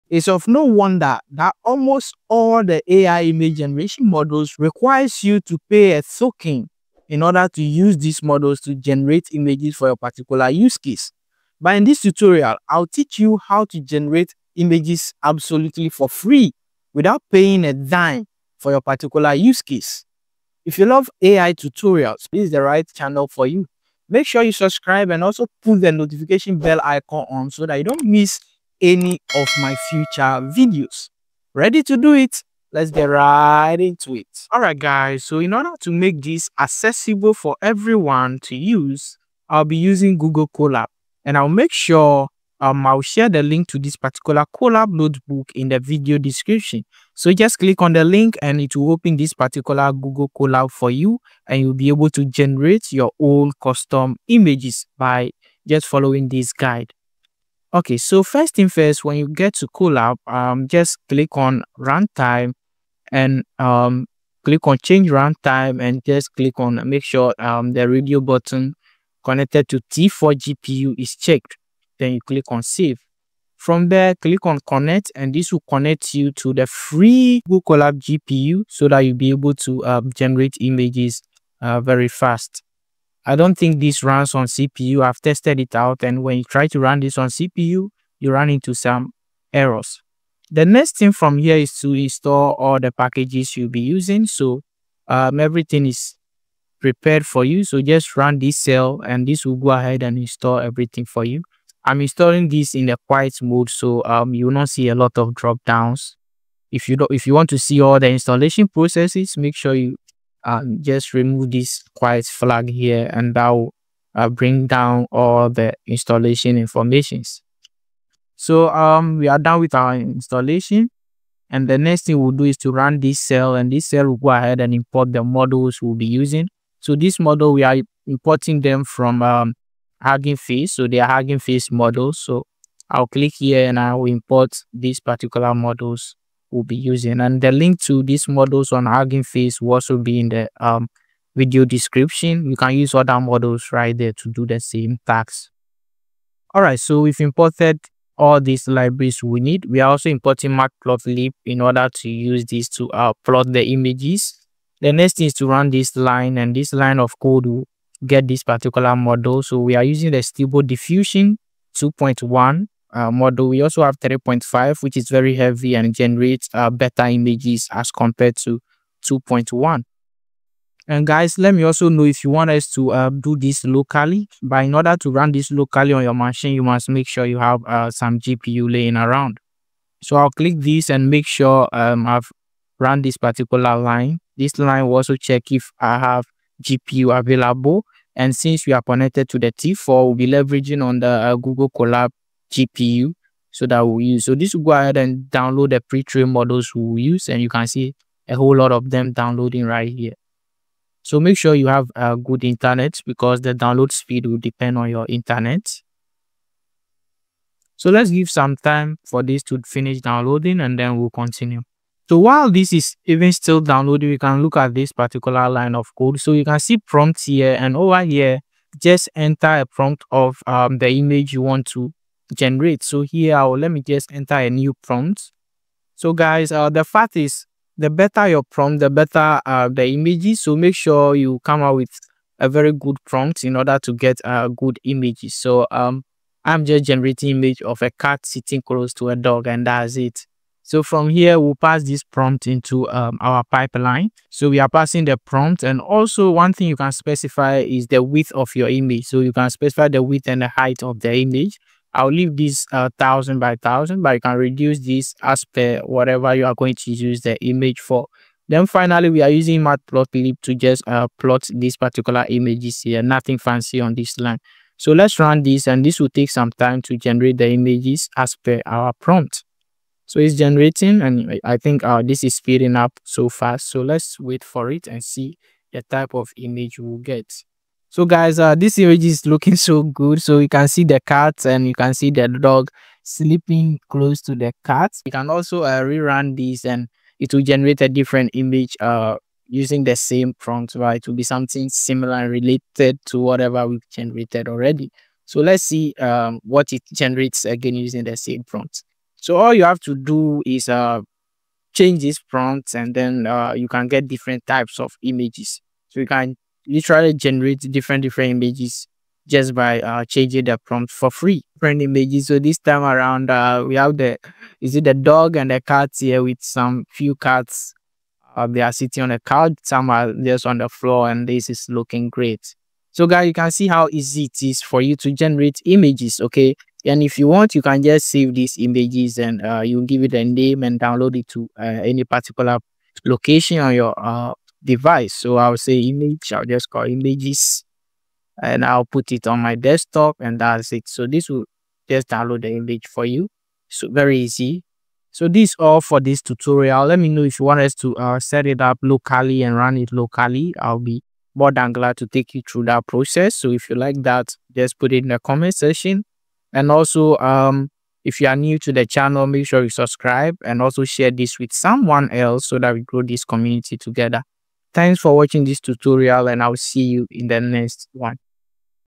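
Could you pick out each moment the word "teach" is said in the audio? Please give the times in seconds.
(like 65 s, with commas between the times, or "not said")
12 s.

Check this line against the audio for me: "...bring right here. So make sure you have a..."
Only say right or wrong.
wrong.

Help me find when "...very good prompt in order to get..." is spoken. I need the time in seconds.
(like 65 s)
232 s.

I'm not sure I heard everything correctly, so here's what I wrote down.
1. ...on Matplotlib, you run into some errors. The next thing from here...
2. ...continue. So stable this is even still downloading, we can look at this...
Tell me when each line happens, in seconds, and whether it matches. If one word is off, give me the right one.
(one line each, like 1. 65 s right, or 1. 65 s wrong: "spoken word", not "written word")
1. 87 s wrong: "CPU", not "Matplotlib"
2. 211 s wrong: "while", not "stable".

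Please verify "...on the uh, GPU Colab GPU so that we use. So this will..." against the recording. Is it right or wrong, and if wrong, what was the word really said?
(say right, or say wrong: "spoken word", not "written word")
wrong: "Google", not "GPU".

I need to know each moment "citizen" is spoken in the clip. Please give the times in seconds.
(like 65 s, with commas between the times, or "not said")
not said.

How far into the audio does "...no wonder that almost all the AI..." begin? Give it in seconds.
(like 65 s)
0 s.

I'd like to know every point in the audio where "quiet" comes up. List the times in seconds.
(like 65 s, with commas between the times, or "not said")
103 s, 111 s.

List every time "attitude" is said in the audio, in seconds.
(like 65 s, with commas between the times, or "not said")
not said.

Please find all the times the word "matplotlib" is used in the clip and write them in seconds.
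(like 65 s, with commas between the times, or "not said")
150 s, 259 s.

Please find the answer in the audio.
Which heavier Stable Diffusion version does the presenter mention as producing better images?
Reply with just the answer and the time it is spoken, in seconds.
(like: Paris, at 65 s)
3.5, at 163 s.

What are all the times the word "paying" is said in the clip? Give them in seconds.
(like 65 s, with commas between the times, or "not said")
17 s.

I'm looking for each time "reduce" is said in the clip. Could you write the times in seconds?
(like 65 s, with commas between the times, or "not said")
254 s.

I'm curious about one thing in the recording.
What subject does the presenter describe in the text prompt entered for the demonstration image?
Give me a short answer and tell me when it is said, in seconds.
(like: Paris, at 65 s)
a cat sitting close to a dog, at 237 s.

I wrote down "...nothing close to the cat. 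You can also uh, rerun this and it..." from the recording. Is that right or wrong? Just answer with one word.
wrong.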